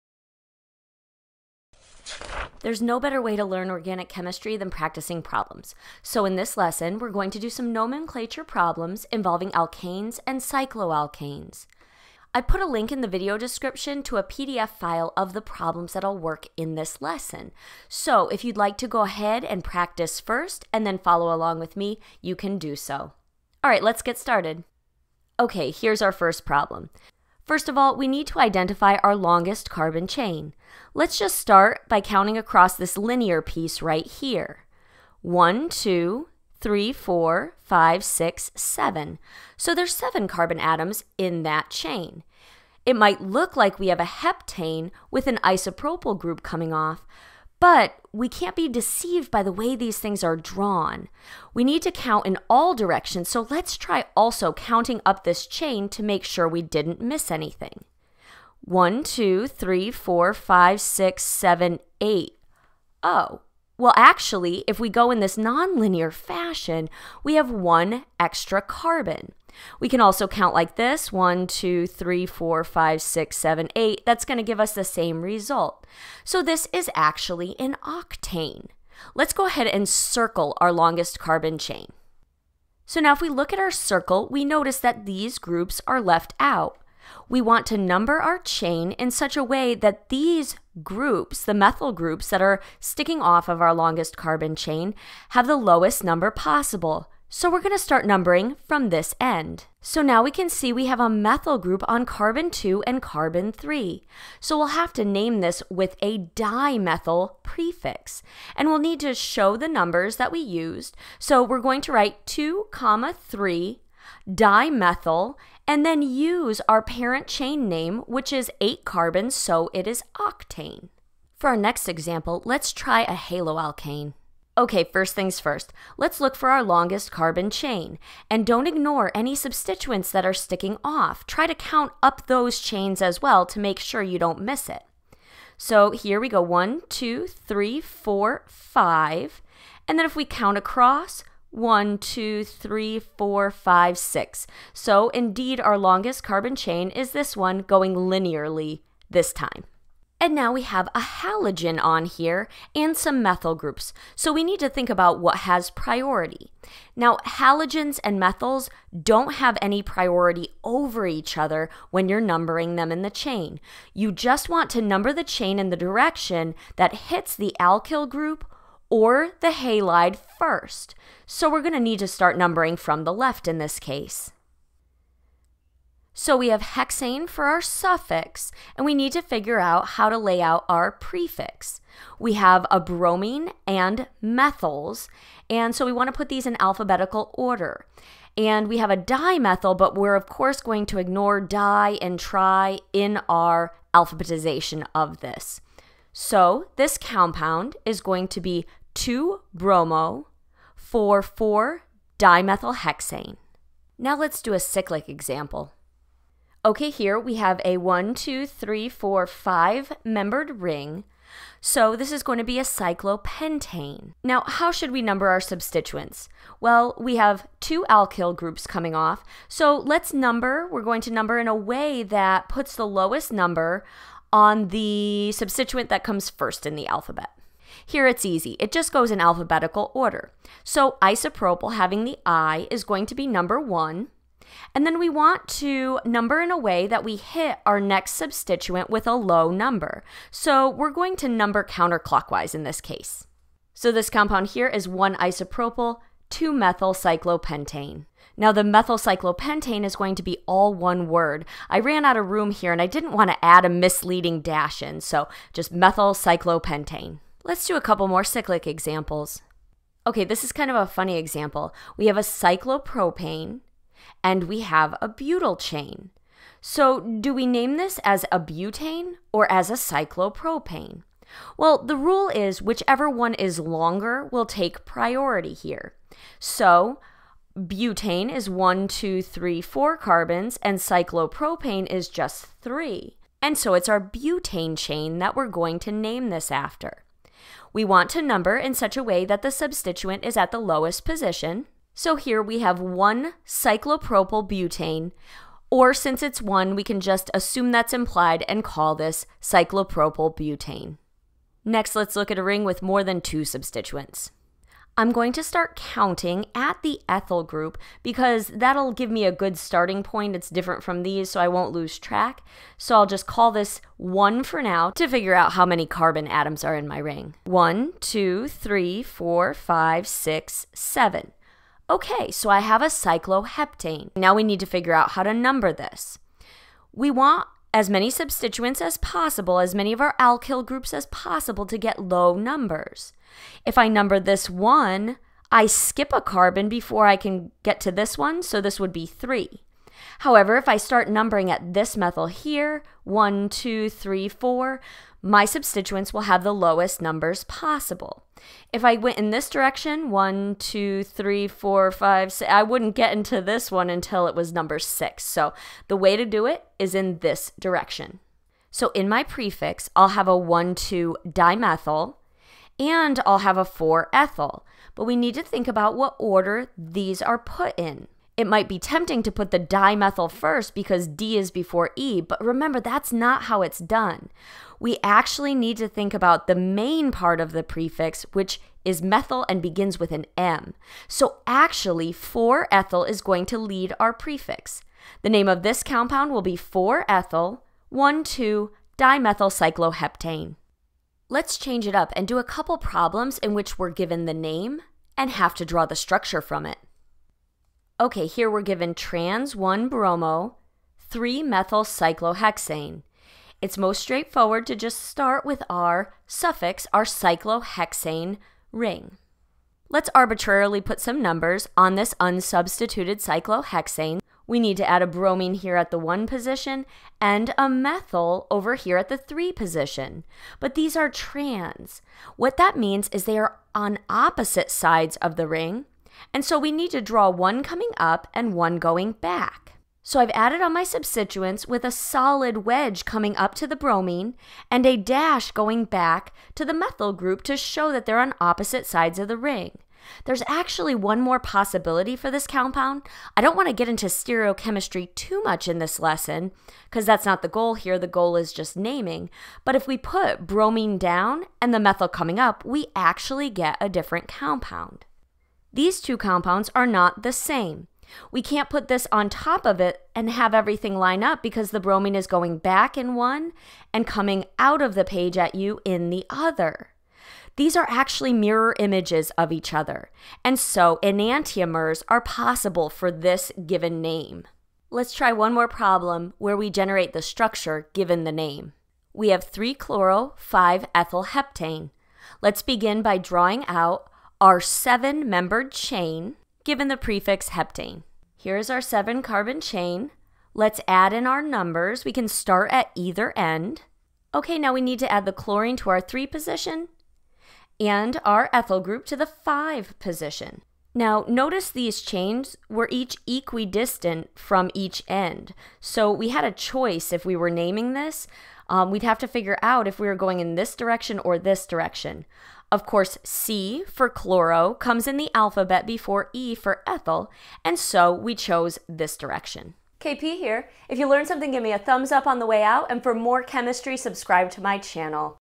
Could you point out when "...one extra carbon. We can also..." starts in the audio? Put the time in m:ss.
1:07.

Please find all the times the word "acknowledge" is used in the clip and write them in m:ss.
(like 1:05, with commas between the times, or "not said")
not said.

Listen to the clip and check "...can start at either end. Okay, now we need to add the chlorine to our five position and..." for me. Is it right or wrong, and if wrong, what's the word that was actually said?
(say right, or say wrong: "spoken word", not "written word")
wrong: "three", not "five".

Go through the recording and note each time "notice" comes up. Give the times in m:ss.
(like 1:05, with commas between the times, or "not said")
1:24, 8:21.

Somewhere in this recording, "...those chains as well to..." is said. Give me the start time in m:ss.
2:12.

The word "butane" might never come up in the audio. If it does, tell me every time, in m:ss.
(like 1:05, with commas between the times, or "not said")
4:28, 4:37, 4:43, 4:54, 5:00.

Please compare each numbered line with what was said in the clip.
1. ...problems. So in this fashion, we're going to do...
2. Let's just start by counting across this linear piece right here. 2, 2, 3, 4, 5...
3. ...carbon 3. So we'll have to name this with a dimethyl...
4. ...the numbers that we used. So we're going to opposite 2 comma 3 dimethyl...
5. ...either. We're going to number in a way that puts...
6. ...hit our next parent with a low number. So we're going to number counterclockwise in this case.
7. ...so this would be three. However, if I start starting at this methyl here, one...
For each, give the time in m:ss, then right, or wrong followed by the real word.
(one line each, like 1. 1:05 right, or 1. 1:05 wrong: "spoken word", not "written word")
1. 0:05 wrong: "lesson", not "fashion"
2. 0:30 wrong: "1", not "2"
3. 1:43 right
4. 1:49 wrong: "write", not "opposite"
5. 3:40 wrong: "number", not "either"
6. 3:57 wrong: "substituent", not "parent"
7. 5:38 wrong: "numbering", not "starting".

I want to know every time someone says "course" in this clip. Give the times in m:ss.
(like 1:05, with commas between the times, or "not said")
3:10, 8:32.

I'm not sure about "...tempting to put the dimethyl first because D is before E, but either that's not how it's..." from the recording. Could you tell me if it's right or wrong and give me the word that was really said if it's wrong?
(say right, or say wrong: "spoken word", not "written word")
wrong: "remember", not "either".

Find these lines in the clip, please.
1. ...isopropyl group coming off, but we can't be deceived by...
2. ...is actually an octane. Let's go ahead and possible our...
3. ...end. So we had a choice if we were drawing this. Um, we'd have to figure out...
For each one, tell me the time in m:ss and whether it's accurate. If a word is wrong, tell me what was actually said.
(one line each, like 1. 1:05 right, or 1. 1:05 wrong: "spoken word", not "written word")
1. 0:45 right
2. 1:16 wrong: "circle", not "possible"
3. 8:25 wrong: "naming", not "drawing".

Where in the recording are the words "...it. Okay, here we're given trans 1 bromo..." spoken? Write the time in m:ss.
6:36.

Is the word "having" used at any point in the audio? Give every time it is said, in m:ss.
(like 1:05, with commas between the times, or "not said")
3:51.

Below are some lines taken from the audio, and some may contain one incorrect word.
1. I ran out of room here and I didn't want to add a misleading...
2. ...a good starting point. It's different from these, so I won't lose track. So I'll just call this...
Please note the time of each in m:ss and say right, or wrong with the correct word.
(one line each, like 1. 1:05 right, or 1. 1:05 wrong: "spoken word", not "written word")
1. 4:11 right
2. 5:09 right.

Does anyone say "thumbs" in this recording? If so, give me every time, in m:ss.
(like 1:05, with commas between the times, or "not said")
8:41.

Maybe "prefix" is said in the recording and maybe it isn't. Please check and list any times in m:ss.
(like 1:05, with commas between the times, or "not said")
1:47, 3:00, 5:59, 6:17, 6:24, 8:06.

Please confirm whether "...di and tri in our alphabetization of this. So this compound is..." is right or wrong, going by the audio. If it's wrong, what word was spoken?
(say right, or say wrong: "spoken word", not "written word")
right.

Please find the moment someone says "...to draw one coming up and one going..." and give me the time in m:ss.
7:06.